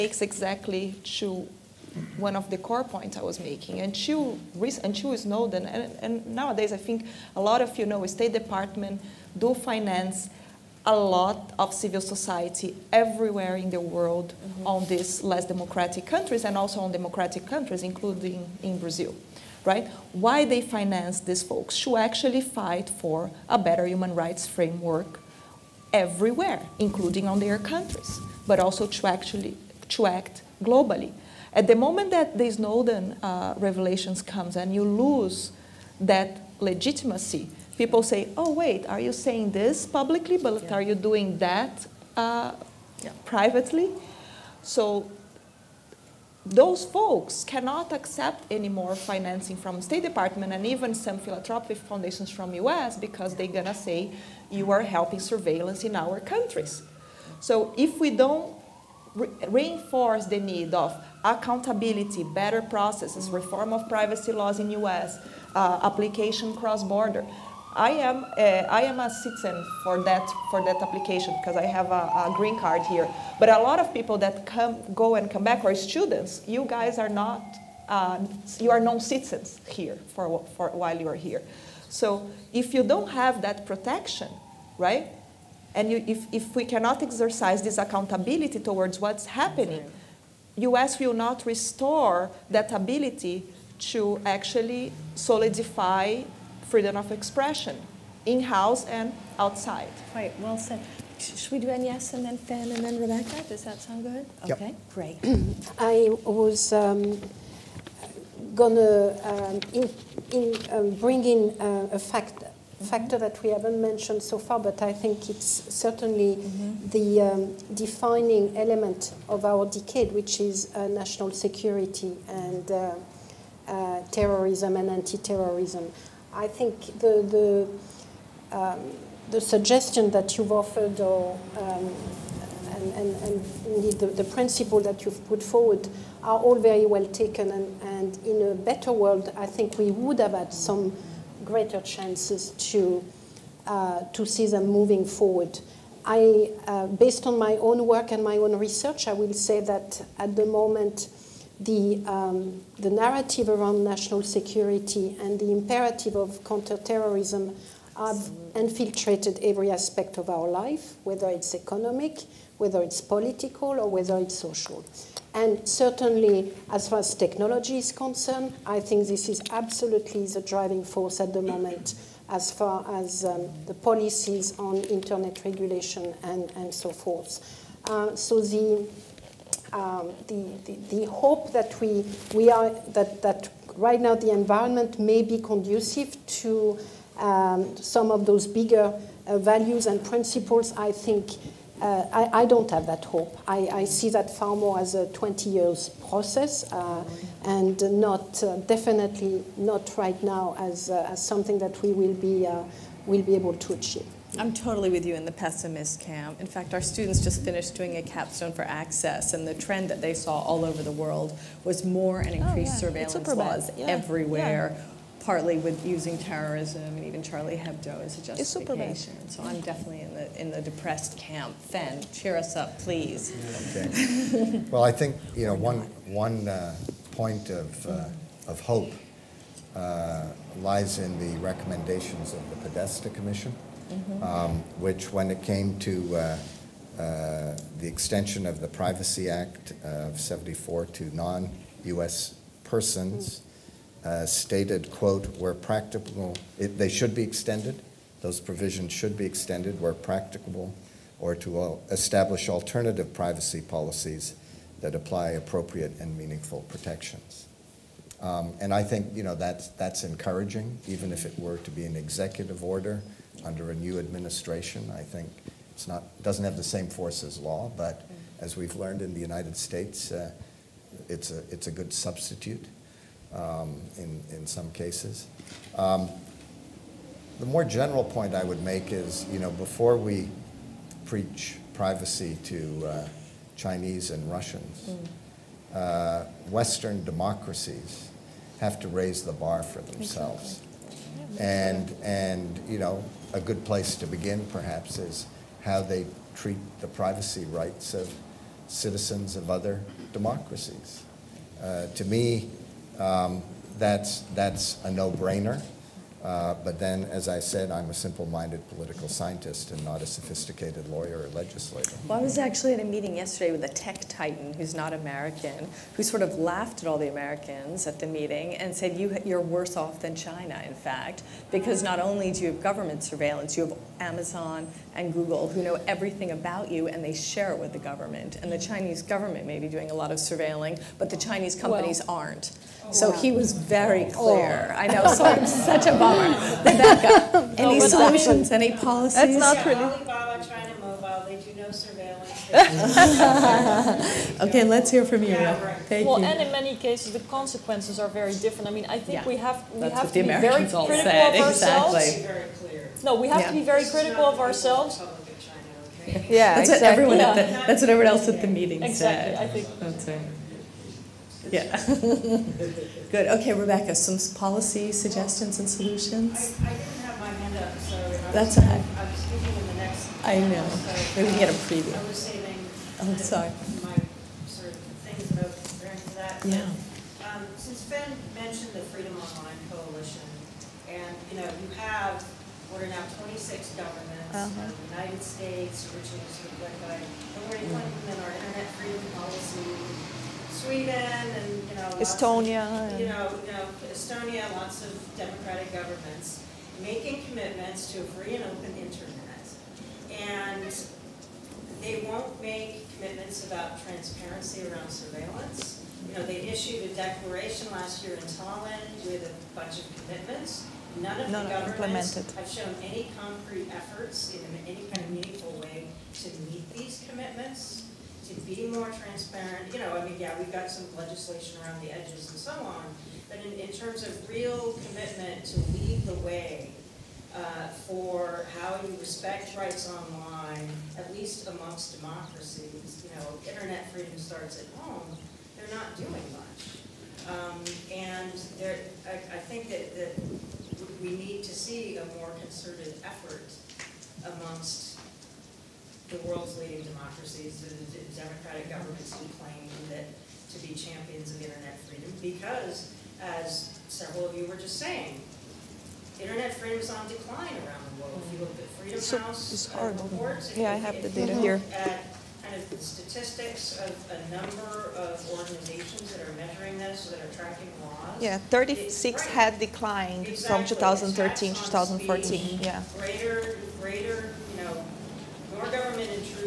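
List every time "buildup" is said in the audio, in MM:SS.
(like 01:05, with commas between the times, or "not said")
not said.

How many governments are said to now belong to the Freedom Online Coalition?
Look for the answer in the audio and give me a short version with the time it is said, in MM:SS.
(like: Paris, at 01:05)
26, at 06:23.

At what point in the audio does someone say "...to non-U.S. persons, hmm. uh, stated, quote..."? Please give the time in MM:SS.
04:00.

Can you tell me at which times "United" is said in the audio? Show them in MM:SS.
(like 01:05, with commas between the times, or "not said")
04:29, 06:24.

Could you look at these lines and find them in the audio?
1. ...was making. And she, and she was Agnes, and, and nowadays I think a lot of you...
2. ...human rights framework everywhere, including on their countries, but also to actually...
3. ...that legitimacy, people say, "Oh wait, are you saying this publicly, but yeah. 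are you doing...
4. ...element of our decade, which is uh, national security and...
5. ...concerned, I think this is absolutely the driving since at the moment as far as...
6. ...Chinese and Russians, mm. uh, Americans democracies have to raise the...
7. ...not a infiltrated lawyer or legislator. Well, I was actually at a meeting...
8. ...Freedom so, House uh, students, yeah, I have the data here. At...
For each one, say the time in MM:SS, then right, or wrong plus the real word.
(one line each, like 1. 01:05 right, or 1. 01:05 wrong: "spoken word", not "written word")
1. 00:03 wrong: "Snowden", not "Agnes"
2. 00:23 right
3. 00:35 right
4. 01:58 right
5. 02:47 wrong: "force", not "since"
6. 04:43 wrong: "Western", not "Americans"
7. 05:09 wrong: "sophisticated", not "infiltrated"
8. 07:38 wrong: "reports", not "students".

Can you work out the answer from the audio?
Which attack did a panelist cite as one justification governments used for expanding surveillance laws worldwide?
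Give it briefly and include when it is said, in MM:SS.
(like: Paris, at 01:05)
Charlie Hebdo, at 03:37.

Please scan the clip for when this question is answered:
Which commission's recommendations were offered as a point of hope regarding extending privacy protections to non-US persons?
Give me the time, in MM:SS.
03:52.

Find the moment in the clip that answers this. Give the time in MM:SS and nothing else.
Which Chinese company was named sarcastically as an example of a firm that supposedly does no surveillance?
05:39.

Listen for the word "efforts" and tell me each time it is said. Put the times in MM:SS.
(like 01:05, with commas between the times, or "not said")
06:53, 07:23.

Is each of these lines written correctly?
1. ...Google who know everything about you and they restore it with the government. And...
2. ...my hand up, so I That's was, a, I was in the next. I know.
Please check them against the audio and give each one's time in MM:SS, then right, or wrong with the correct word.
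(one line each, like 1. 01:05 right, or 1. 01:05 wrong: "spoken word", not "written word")
1. 05:25 wrong: "share", not "restore"
2. 06:07 right.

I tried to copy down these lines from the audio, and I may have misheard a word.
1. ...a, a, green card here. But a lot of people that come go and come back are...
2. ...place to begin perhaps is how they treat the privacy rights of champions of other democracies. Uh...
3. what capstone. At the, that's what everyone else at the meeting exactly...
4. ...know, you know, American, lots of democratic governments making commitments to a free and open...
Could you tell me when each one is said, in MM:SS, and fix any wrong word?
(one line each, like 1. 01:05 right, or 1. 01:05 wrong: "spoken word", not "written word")
1. 01:11 right
2. 04:53 wrong: "citizens", not "champions"
3. 05:57 wrong: "everyone", not "capstone"
4. 06:33 wrong: "Estonia", not "American".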